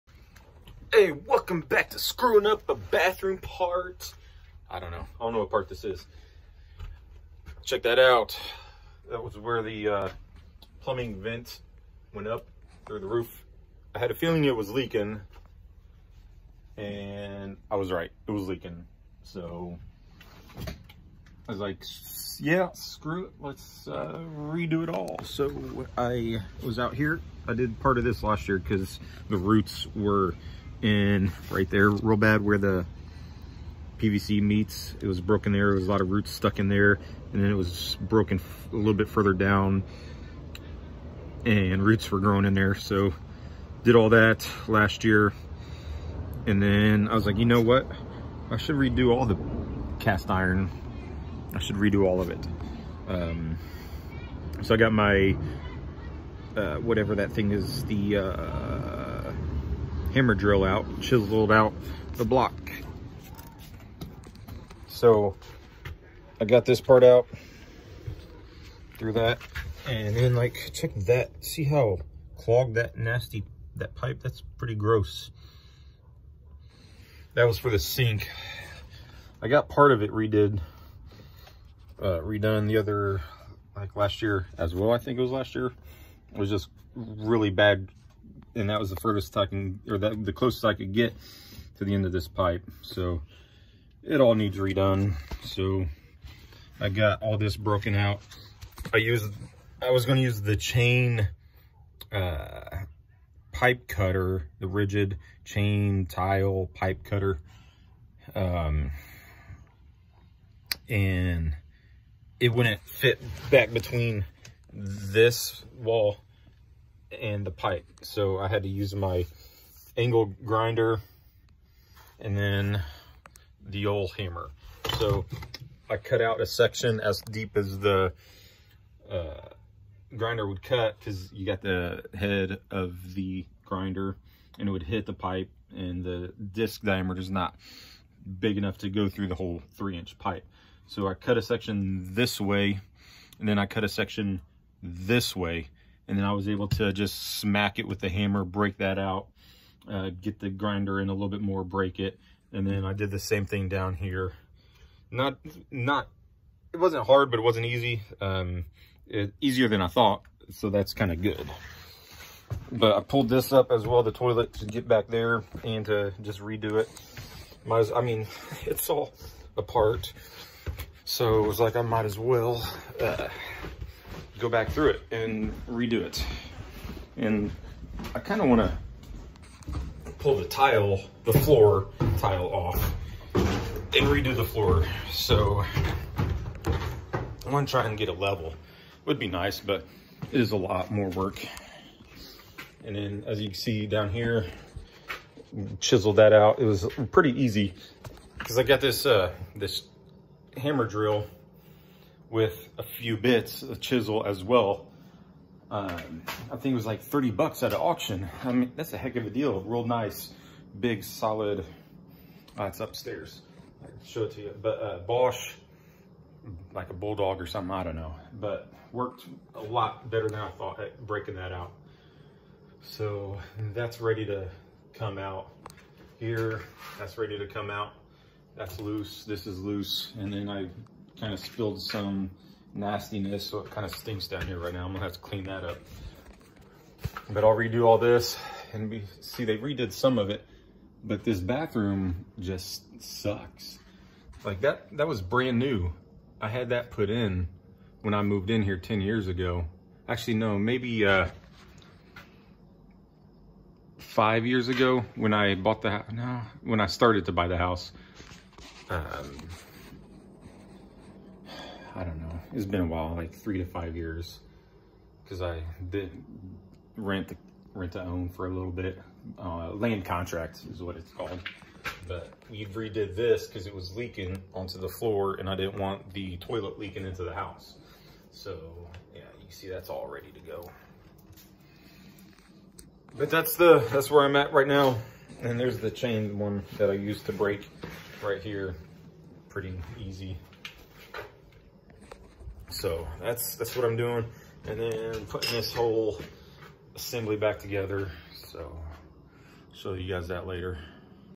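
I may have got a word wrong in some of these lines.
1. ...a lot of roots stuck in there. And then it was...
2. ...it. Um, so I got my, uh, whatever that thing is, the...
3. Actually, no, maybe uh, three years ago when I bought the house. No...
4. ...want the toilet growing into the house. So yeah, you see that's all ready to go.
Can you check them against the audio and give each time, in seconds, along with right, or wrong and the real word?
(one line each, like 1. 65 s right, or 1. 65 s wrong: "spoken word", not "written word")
1. 35 s right
2. 52 s right
3. 250 s wrong: "five", not "three"
4. 275 s wrong: "leaking", not "growing".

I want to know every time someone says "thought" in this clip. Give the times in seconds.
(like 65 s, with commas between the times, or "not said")
159 s, 220 s.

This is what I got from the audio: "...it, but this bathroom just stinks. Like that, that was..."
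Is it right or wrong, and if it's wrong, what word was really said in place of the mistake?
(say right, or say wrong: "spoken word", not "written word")
wrong: "sucks", not "stinks".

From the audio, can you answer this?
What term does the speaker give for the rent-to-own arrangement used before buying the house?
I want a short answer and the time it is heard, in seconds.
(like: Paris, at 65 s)
Land contract, at 269 s.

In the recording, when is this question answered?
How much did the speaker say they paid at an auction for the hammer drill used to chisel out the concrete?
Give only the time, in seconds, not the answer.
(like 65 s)
207 s.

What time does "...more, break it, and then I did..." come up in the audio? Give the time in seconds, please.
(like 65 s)
151 s.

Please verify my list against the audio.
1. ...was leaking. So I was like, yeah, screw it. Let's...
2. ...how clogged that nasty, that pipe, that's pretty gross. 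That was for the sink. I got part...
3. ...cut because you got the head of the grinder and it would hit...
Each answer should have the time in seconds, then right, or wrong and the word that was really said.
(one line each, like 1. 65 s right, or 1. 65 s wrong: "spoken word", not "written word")
1. 18 s right
2. 71 s right
3. 130 s right.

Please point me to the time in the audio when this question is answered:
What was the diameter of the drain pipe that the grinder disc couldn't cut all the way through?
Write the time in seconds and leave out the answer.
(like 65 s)
139 s.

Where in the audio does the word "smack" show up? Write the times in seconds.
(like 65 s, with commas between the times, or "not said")
147 s.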